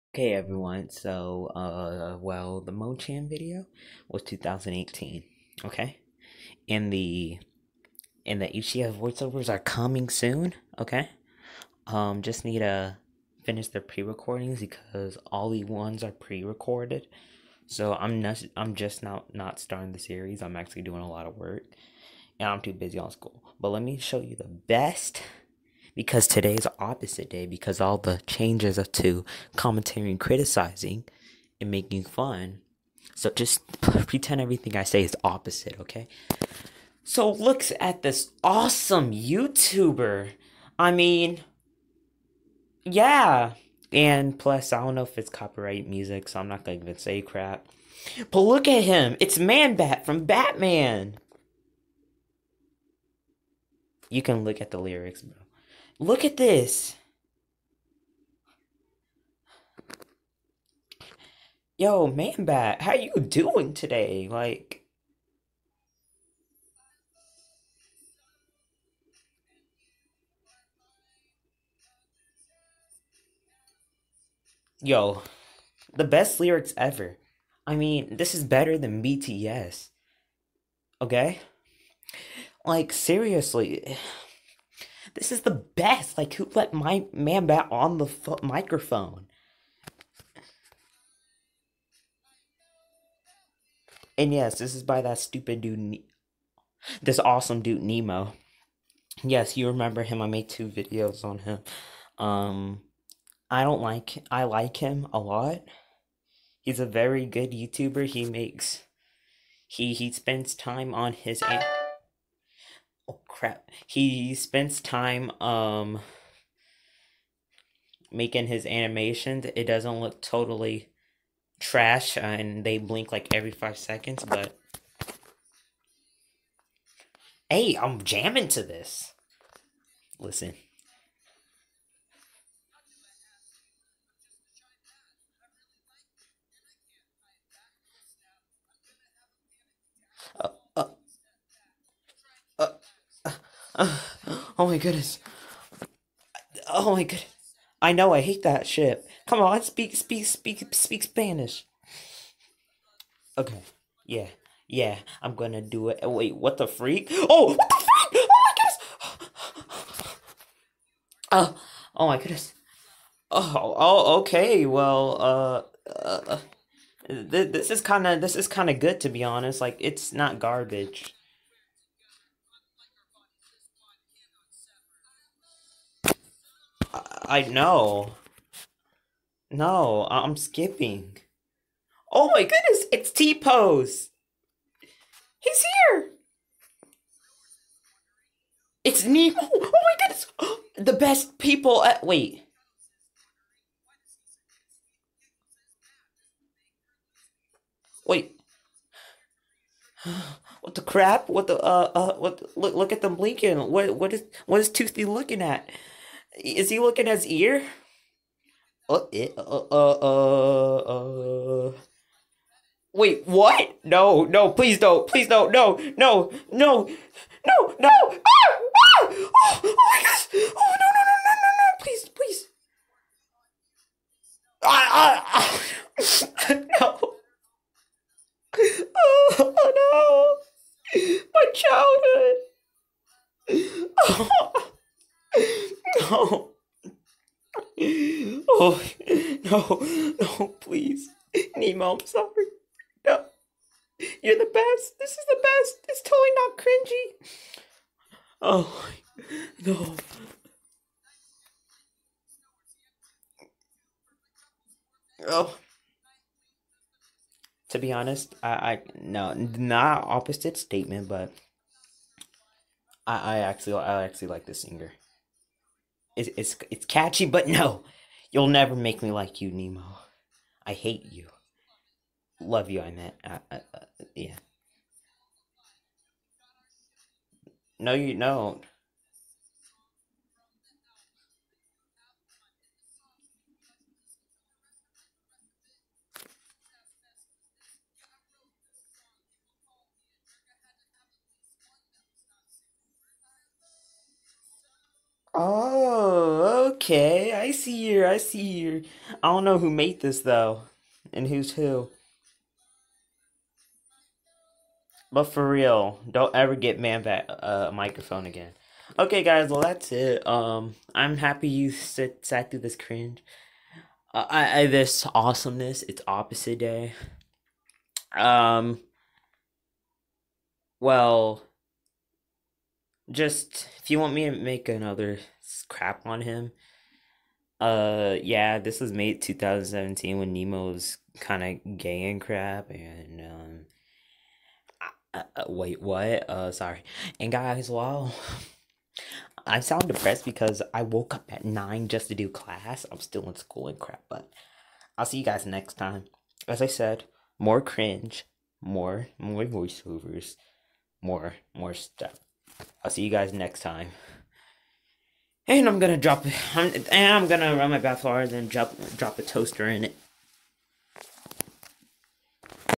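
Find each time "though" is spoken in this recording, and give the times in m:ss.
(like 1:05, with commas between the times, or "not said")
5:00.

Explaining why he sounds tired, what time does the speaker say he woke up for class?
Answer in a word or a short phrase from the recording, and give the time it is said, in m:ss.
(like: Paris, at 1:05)
9, at 5:41.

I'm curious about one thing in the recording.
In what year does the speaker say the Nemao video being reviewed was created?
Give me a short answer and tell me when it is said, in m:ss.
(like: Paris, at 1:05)
2017, at 5:29.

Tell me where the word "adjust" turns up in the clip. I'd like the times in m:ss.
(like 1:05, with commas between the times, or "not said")
not said.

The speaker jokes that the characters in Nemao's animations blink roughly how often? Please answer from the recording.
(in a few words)
Every 5 seconds.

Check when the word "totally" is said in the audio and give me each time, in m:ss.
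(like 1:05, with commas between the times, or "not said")
2:00, 4:06.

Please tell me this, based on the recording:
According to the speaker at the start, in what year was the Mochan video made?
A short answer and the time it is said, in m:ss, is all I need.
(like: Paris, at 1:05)
2018, at 0:04.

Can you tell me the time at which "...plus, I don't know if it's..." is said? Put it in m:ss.
0:44.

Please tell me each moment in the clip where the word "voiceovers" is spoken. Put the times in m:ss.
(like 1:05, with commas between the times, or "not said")
0:08, 5:49.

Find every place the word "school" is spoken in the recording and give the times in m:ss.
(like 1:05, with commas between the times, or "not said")
0:23, 5:43.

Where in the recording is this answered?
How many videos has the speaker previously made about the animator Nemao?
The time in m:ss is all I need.
1:40.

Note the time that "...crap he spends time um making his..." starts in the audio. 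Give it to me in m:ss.
1:53.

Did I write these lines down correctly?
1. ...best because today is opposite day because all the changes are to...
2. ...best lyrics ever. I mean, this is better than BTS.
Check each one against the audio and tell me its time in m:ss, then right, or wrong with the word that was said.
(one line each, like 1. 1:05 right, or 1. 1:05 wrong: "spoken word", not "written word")
1. 0:24 right
2. 1:16 right.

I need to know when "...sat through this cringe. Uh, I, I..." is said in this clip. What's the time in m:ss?
5:12.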